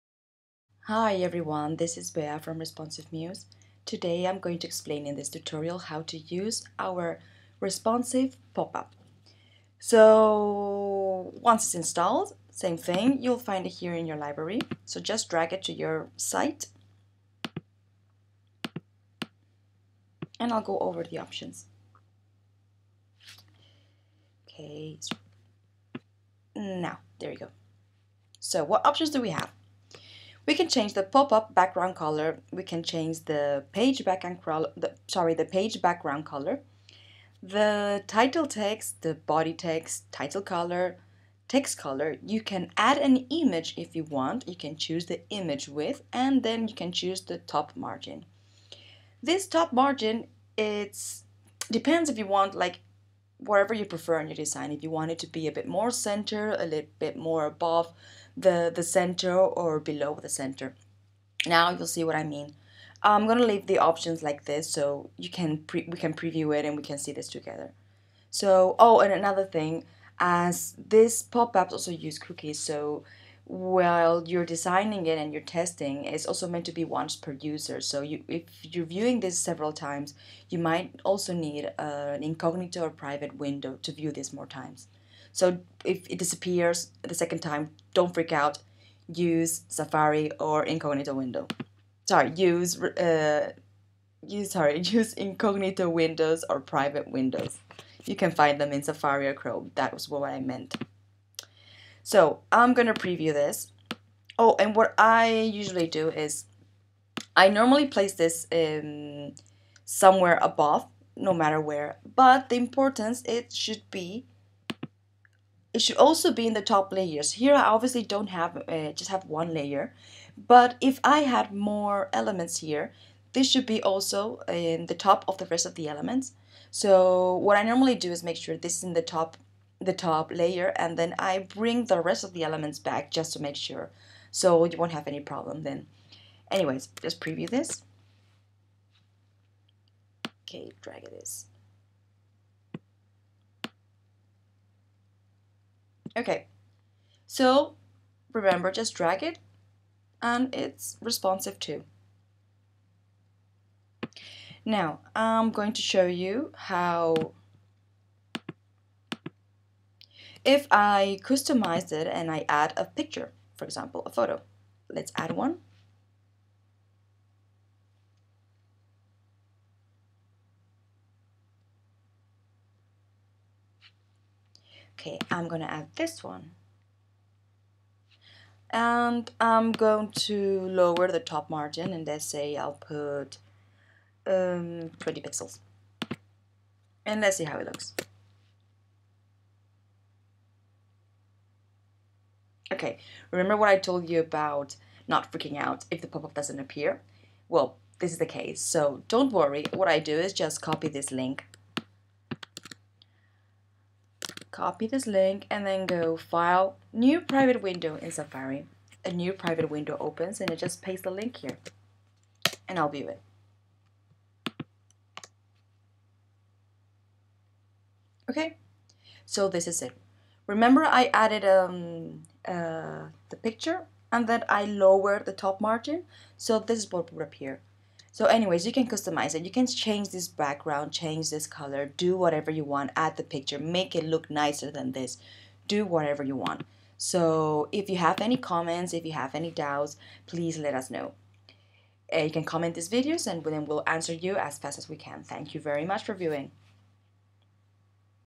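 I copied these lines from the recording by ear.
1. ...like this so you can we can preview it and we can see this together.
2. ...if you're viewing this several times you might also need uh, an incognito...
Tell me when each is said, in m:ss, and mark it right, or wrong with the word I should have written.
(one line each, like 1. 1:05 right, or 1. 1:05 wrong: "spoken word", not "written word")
1. 1:04 right
2. 1:18 right.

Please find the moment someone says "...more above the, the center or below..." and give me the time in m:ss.
0:57.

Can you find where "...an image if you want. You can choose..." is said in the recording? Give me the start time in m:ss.
0:42.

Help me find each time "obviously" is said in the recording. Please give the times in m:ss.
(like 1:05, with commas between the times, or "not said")
1:57.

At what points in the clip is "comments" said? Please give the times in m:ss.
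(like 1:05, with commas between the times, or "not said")
3:58, 4:02.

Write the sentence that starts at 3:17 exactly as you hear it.
Well, this is the case, so don't worry.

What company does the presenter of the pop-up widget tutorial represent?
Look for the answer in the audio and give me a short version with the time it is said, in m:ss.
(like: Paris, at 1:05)
Responsive Muse, at 0:02.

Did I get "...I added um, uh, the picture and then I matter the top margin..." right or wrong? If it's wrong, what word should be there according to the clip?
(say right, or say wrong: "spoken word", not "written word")
wrong: "lower", not "matter".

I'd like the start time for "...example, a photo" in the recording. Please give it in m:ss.
2:43.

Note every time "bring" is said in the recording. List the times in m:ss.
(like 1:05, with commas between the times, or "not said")
2:11.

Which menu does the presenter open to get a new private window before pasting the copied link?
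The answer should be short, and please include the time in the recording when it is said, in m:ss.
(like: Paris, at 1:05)
File, at 3:26.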